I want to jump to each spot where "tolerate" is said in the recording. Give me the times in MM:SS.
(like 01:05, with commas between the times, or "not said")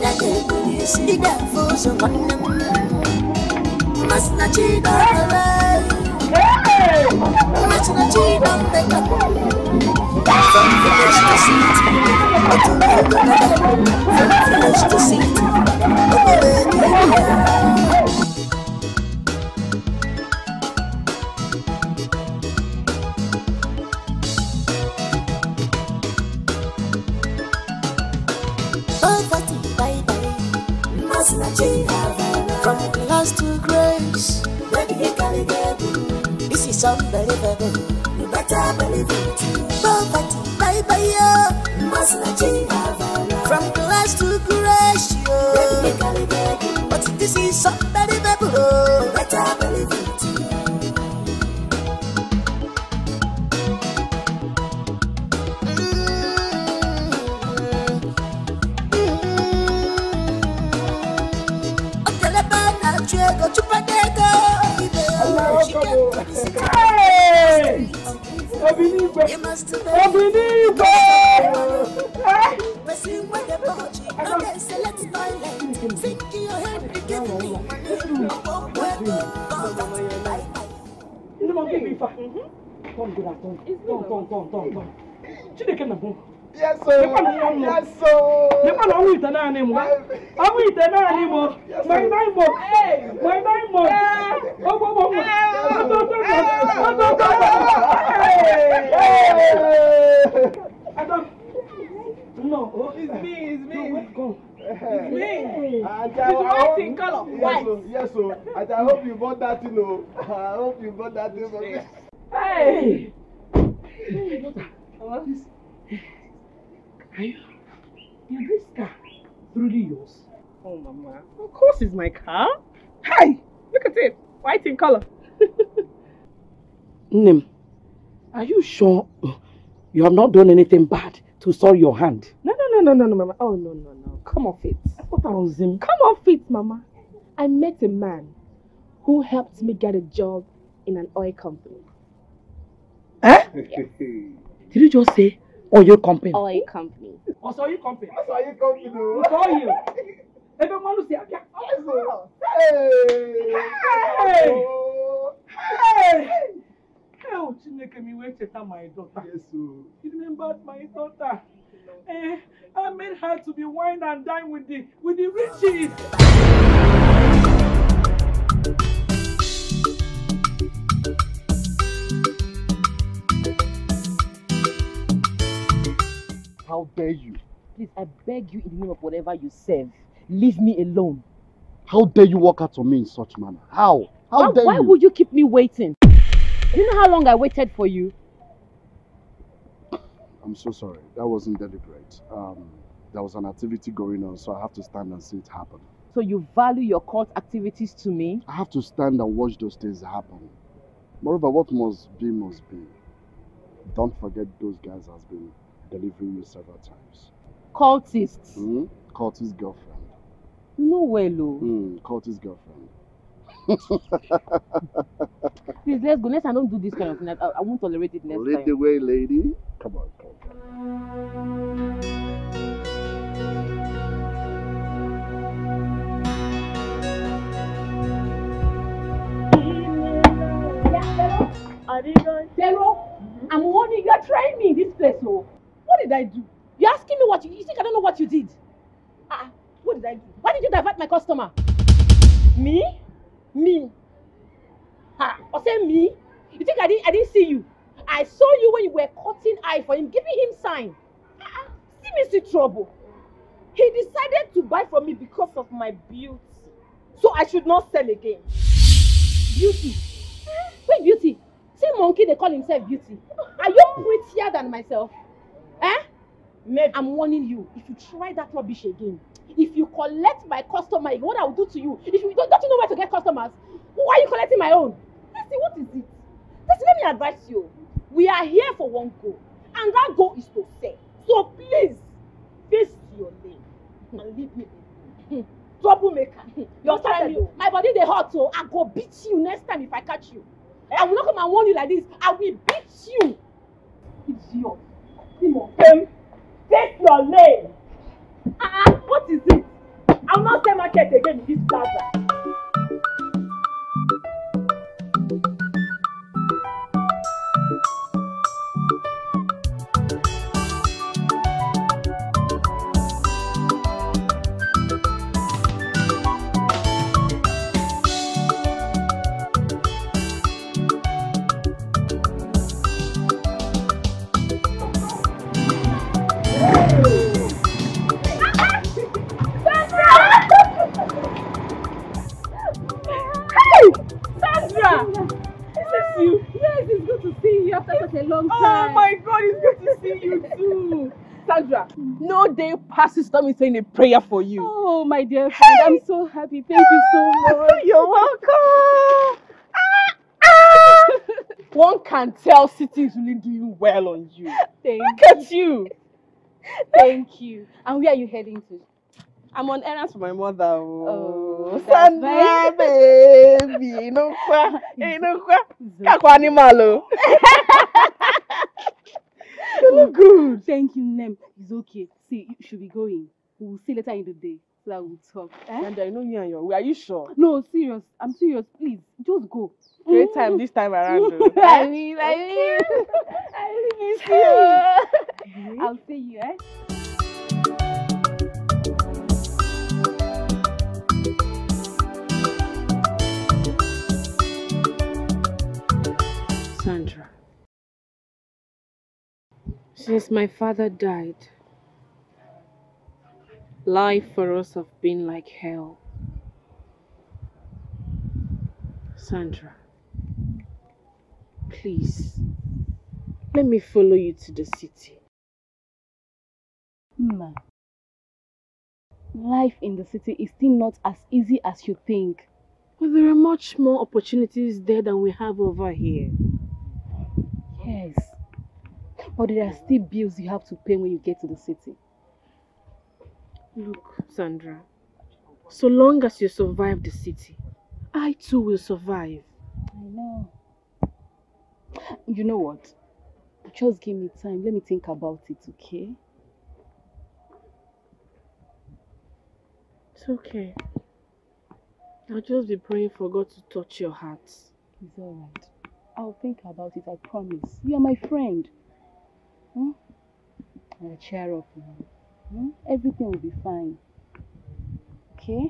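03:37.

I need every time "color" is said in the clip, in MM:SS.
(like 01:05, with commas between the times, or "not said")
01:46, 02:04.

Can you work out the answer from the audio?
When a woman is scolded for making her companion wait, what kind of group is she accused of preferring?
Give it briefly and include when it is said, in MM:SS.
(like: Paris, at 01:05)
Cult, at 03:17.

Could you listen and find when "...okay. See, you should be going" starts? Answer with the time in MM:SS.
06:11.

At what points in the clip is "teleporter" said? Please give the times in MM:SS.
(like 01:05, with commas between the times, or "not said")
not said.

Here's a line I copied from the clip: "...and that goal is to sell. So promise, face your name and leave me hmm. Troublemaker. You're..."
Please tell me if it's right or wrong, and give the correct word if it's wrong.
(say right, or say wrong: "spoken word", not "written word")
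wrong: "please", not "promise".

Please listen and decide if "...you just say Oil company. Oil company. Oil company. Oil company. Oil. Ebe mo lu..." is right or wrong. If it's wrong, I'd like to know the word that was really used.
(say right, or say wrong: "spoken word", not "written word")
right.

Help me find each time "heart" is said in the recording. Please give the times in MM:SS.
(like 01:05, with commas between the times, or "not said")
07:34.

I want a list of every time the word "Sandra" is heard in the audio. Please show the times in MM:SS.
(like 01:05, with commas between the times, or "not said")
05:41, 06:01, 06:15, 06:36, 06:49, 07:14.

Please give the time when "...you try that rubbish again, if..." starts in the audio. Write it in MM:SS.
04:27.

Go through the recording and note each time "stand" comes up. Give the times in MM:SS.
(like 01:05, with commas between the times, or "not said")
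03:14, 03:18.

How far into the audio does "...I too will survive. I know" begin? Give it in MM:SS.
07:18.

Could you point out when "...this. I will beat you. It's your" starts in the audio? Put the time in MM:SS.
04:51.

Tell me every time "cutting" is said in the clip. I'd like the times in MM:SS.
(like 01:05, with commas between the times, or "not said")
04:09.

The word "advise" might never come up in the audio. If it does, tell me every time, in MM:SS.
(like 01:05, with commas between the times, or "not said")
04:37.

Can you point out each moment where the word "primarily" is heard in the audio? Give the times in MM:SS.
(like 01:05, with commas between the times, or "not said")
not said.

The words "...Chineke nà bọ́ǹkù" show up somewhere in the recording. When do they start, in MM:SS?
01:25.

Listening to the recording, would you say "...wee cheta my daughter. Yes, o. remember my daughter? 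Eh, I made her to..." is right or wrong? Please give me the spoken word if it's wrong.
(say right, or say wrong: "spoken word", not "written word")
right.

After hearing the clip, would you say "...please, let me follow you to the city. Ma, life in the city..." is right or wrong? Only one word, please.
right.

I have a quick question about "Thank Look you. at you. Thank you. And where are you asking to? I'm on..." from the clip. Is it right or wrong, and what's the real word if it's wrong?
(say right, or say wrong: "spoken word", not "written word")
wrong: "heading", not "asking".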